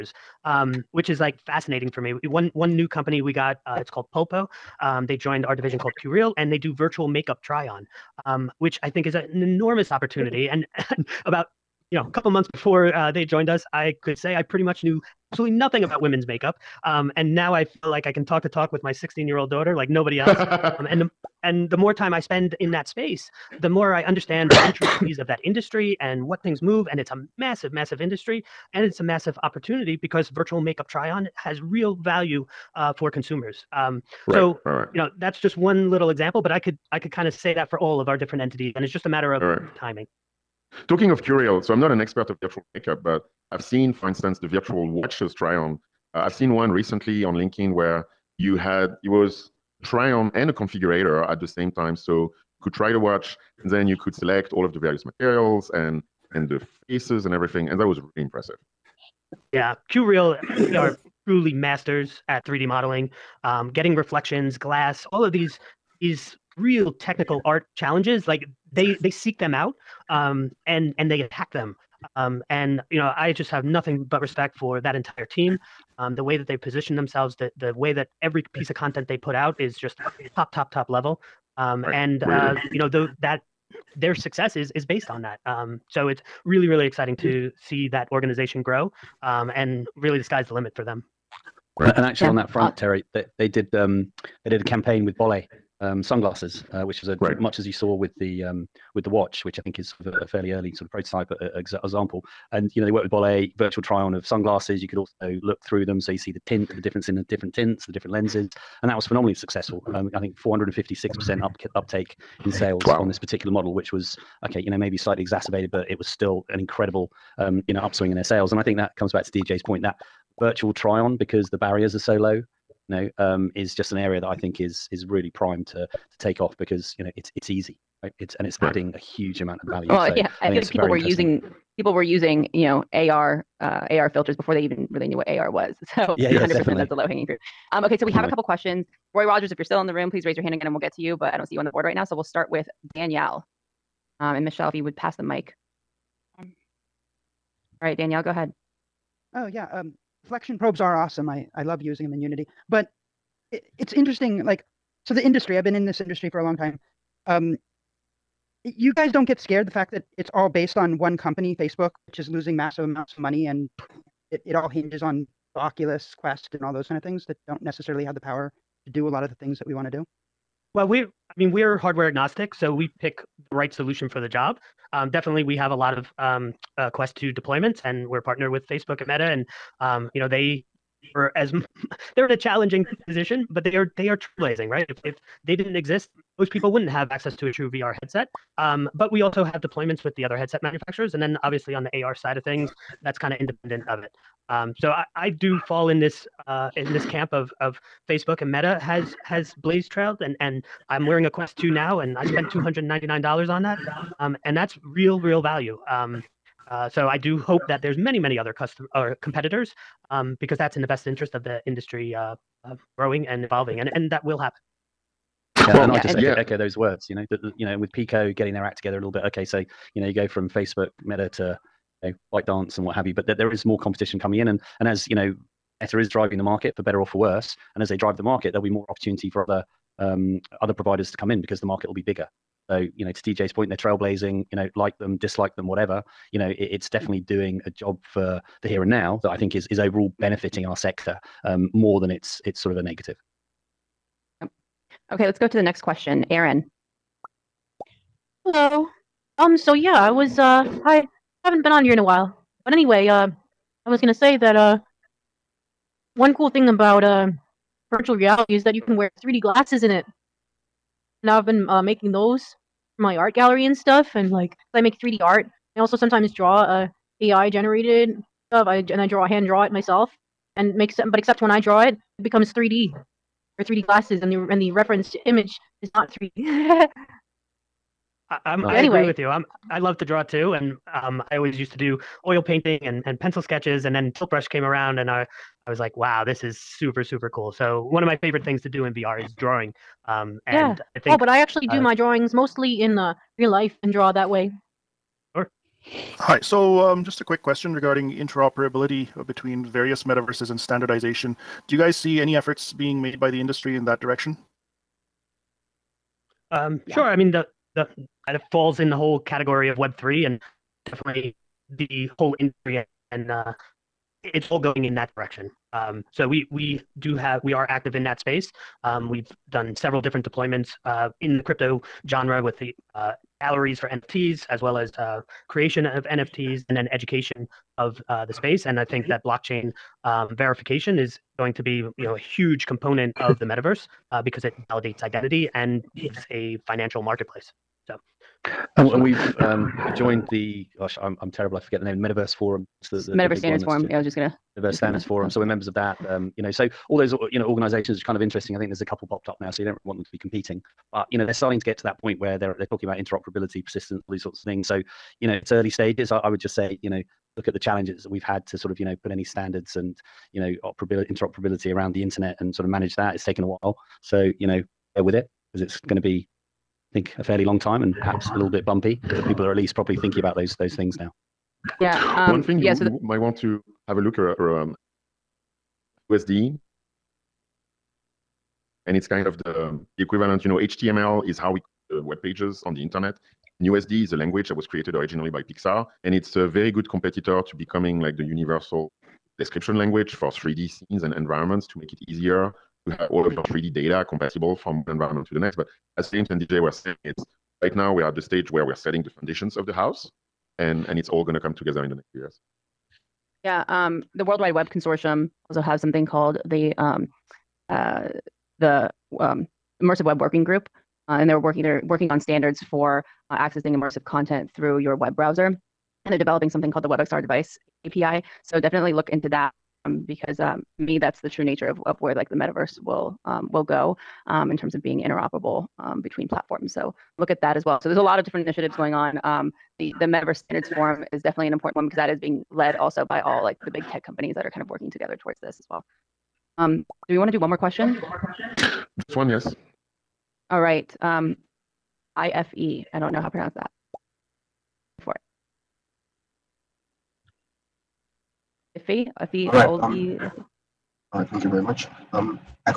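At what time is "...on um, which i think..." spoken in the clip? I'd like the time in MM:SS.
00:07.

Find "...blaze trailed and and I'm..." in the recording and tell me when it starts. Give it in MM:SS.
03:19.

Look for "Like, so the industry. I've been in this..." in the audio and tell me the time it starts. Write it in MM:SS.
02:34.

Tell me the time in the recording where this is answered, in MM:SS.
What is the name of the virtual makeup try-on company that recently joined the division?
00:04.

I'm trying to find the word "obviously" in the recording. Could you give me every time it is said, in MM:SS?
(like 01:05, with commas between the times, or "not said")
03:11.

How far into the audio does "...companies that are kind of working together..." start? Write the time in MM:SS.
07:14.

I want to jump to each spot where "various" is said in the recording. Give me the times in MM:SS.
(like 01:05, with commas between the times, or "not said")
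00:54, 04:59.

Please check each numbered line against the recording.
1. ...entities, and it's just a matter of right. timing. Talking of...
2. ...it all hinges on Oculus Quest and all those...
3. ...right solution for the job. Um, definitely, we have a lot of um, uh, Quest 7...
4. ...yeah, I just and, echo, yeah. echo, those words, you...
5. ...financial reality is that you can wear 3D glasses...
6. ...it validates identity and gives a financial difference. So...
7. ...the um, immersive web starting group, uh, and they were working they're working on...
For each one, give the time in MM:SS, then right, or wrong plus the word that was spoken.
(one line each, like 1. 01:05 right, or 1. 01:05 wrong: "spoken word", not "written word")
1. 00:38 right
2. 02:44 right
3. 02:53 wrong: "2", not "7"
4. 03:35 right
5. 04:17 wrong: "virtual", not "financial"
6. 05:34 wrong: "marketplace", not "difference"
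7. 06:48 wrong: "working", not "starting".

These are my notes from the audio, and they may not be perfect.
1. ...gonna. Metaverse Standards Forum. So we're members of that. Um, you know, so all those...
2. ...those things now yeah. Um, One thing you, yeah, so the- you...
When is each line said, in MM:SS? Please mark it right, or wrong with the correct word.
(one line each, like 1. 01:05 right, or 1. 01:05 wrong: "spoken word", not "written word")
1. 05:44 right
2. 06:10 right.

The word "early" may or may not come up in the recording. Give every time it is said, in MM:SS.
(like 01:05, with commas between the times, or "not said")
01:40, 05:55.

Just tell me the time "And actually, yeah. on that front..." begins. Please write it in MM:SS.
01:31.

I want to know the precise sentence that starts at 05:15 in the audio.
Um, so we we do have we are active in that space.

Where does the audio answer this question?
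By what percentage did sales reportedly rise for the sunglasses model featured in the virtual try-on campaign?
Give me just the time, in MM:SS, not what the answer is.
01:50.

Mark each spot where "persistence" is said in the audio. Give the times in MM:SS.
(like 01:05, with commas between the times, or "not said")
05:53.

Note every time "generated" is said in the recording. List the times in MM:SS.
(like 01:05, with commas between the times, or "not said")
04:27.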